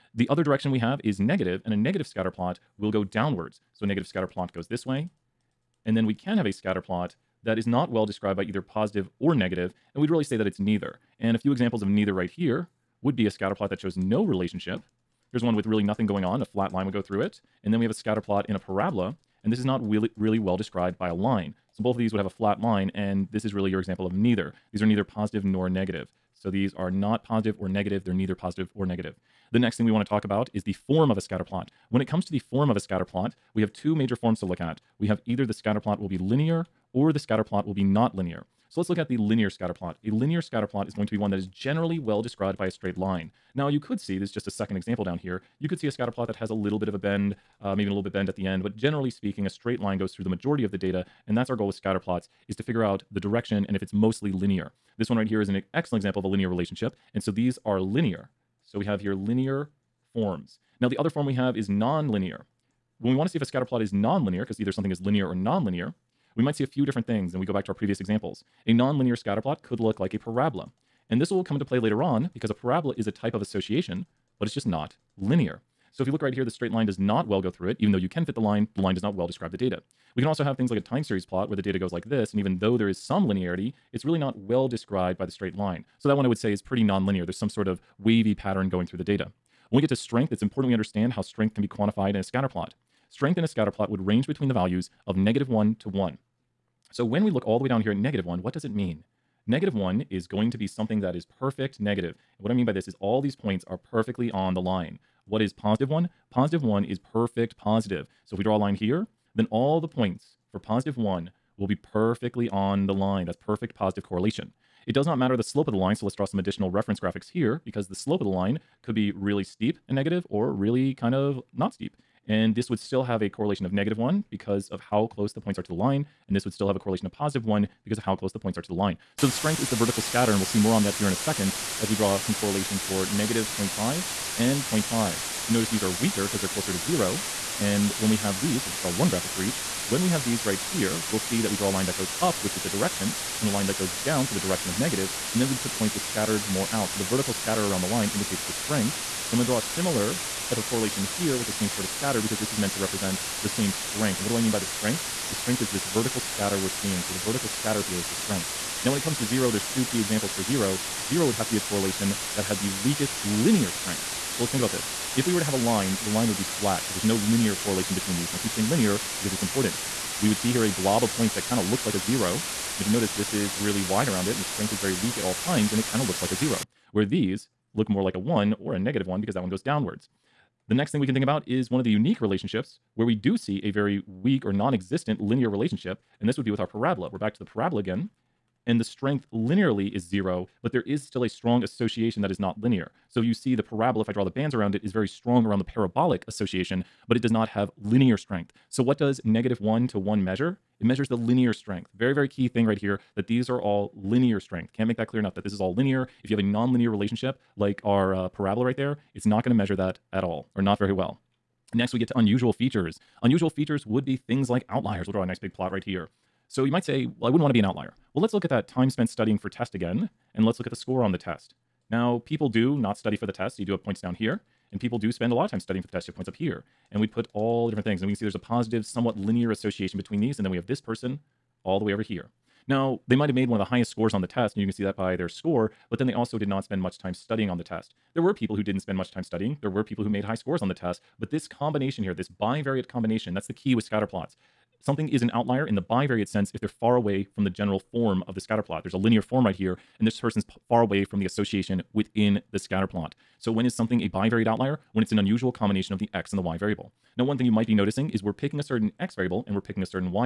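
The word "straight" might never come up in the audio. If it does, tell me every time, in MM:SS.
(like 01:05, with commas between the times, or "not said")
00:42, 00:49, 01:16, 01:25.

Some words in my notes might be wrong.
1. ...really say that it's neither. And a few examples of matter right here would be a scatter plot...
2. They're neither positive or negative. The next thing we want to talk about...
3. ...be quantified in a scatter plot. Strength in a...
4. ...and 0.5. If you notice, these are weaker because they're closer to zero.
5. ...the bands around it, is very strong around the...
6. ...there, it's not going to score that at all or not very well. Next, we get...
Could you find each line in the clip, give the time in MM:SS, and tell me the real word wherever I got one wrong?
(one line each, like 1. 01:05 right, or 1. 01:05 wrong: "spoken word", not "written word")
1. 00:10 wrong: "neither", not "matter"
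2. 00:28 right
3. 01:31 right
4. 02:14 right
5. 03:14 right
6. 03:28 wrong: "measure", not "score".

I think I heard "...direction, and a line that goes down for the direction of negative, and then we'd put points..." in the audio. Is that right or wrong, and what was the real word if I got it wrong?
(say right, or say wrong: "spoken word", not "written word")
right.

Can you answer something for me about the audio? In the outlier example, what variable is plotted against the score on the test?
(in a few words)
time spent studying.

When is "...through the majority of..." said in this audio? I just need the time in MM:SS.
00:50.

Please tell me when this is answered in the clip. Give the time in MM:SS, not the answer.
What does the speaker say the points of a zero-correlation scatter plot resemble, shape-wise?
02:50.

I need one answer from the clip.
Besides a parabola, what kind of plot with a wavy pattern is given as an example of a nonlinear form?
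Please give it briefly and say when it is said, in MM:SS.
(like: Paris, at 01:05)
time series plot, at 01:20.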